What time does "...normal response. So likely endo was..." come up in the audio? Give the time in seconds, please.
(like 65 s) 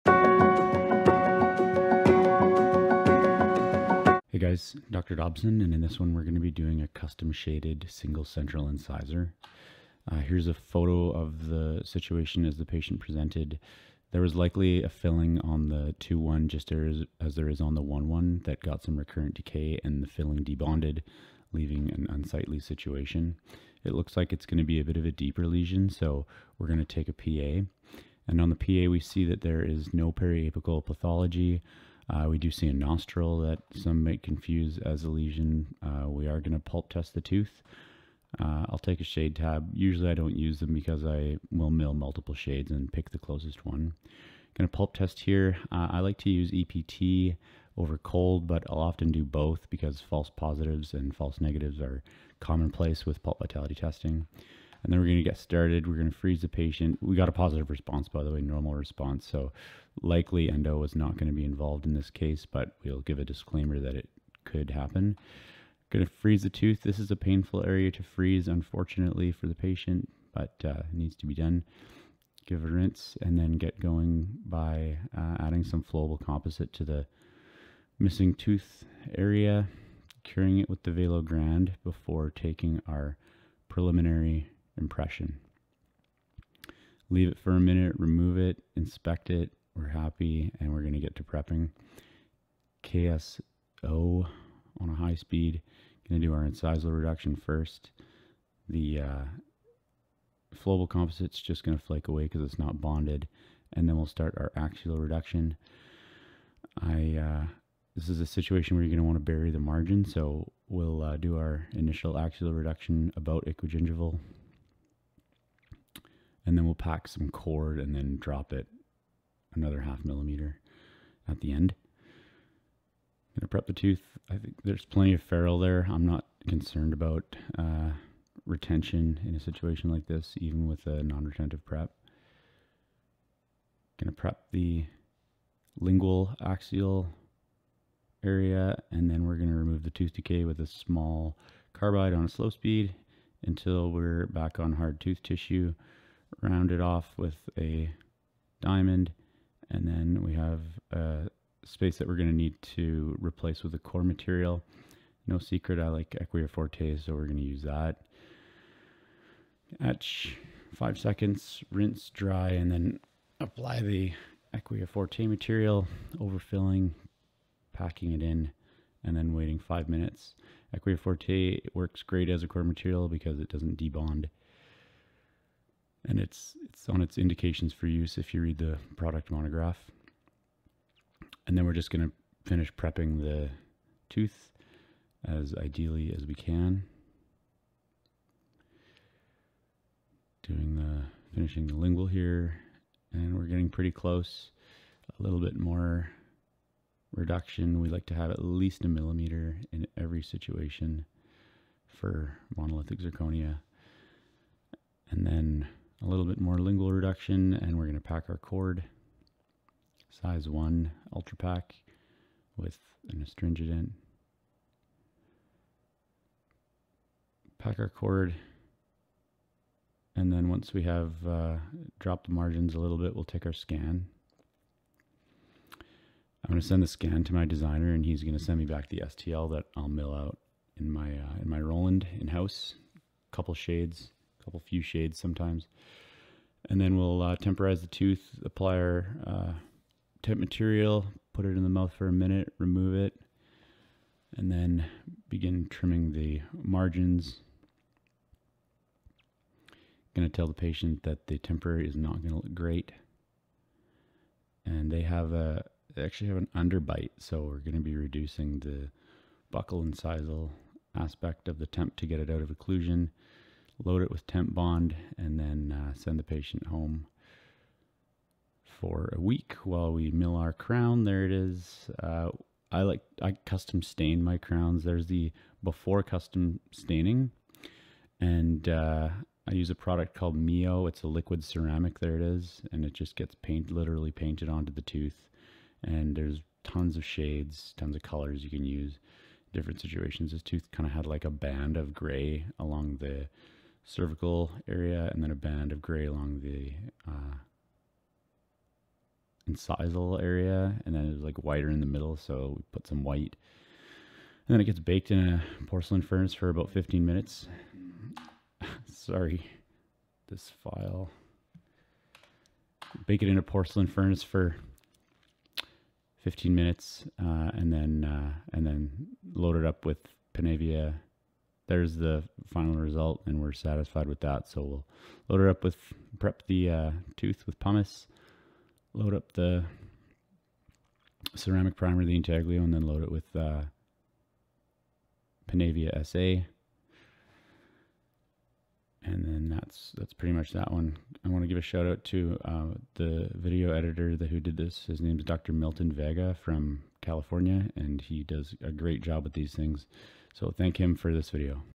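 58 s.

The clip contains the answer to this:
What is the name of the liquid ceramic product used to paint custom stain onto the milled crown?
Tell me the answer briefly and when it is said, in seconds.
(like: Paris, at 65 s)
Miyo, at 280 s.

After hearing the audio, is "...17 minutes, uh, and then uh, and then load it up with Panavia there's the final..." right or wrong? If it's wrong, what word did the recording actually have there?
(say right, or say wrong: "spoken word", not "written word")
wrong: "15", not "17".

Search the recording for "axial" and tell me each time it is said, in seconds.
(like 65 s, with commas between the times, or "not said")
104 s, 112 s, 136 s.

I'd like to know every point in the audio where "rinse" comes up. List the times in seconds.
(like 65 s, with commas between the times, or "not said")
72 s, 161 s.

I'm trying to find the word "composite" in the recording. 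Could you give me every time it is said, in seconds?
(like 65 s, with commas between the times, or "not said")
76 s, 100 s.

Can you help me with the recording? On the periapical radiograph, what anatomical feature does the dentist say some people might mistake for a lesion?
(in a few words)
nostril.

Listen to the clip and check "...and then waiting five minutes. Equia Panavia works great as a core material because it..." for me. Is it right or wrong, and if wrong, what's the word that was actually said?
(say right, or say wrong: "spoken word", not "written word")
wrong: "Forte", not "Panavia".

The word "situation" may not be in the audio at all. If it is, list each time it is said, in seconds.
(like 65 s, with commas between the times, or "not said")
11 s, 22 s, 108 s, 129 s, 200 s, 289 s.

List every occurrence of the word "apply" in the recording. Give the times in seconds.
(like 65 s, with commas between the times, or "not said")
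163 s, 238 s.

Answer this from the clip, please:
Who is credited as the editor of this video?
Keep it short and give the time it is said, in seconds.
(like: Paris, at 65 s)
Dr. Milton Vega, at 345 s.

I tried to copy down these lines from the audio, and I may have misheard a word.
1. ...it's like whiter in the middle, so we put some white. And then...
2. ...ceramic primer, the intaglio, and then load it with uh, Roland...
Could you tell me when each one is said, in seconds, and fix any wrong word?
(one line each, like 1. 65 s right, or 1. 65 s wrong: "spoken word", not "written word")
1. 301 s right
2. 331 s wrong: "Panavia", not "Roland".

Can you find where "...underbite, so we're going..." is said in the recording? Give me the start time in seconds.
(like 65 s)
256 s.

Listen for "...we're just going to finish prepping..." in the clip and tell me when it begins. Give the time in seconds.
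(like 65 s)
181 s.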